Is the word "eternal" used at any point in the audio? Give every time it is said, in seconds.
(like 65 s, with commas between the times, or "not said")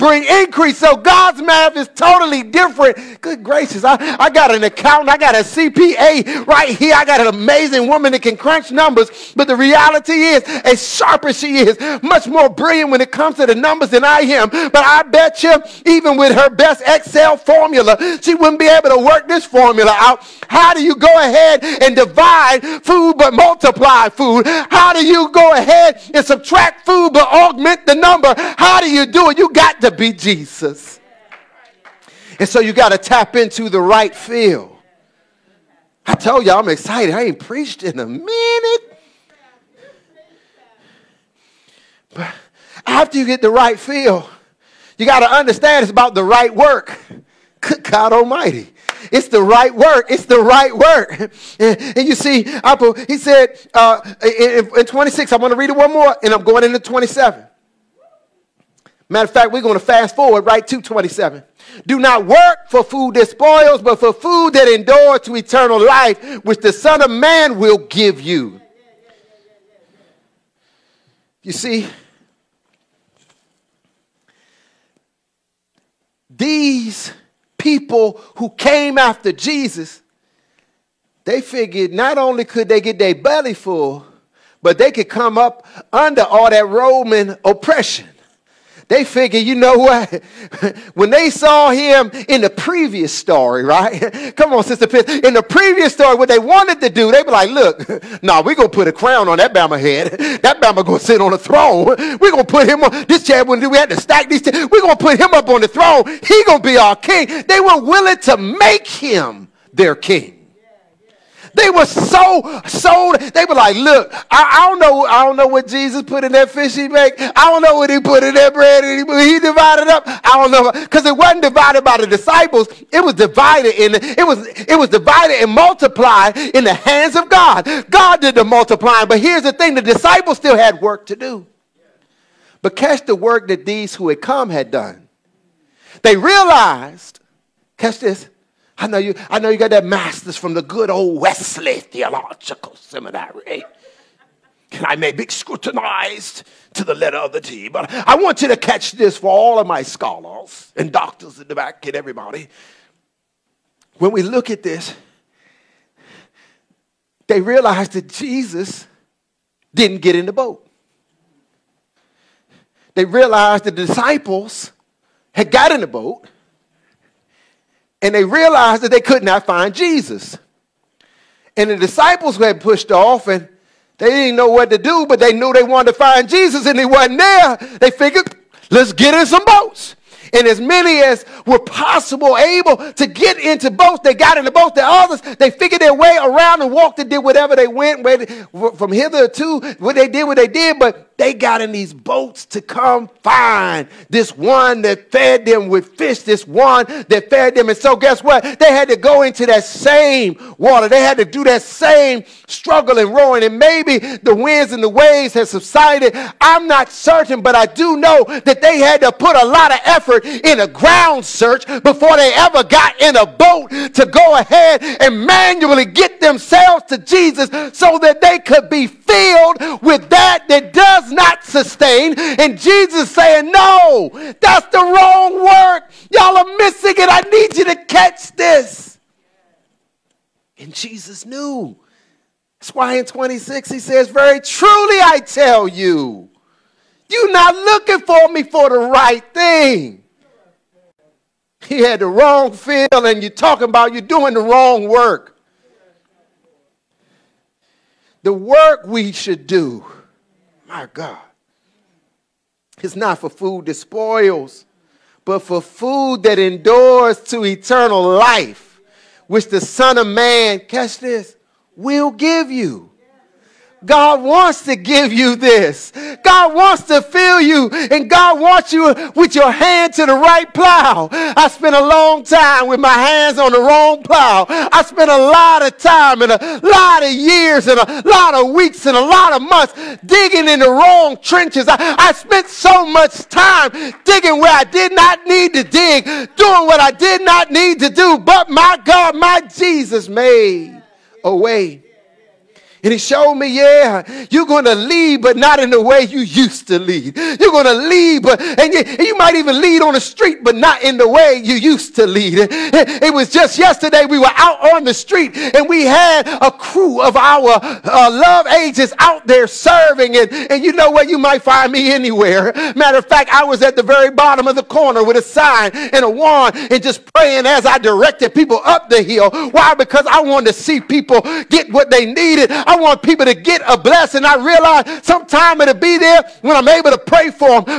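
65 s, 257 s.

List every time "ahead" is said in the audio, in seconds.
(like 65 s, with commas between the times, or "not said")
21 s, 25 s, 214 s.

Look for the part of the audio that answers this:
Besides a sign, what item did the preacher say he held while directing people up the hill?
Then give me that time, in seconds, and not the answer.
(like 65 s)
316 s.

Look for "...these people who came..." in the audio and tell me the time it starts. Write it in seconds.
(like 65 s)
76 s.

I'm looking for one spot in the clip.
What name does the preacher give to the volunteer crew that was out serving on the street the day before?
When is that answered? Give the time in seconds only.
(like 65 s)
308 s.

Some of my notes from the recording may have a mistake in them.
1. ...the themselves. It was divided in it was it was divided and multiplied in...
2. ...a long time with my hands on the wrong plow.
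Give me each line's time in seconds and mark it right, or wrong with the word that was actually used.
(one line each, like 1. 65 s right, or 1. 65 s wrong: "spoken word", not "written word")
1. 121 s wrong: "disciples", not "themselves"
2. 271 s right.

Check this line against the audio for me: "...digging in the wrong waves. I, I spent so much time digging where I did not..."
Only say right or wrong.
wrong.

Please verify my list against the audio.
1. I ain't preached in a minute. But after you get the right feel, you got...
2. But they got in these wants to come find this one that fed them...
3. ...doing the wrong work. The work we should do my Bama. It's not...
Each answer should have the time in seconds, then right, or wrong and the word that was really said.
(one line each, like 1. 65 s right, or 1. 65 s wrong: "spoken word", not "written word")
1. 37 s right
2. 190 s wrong: "boats", not "wants"
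3. 244 s wrong: "God", not "Bama".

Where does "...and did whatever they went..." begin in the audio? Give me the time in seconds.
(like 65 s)
186 s.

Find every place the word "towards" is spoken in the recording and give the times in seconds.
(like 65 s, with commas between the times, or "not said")
not said.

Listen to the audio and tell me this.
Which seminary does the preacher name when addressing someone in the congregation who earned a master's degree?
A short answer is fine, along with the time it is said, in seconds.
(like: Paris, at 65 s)
Wesley Theological Seminary, at 141 s.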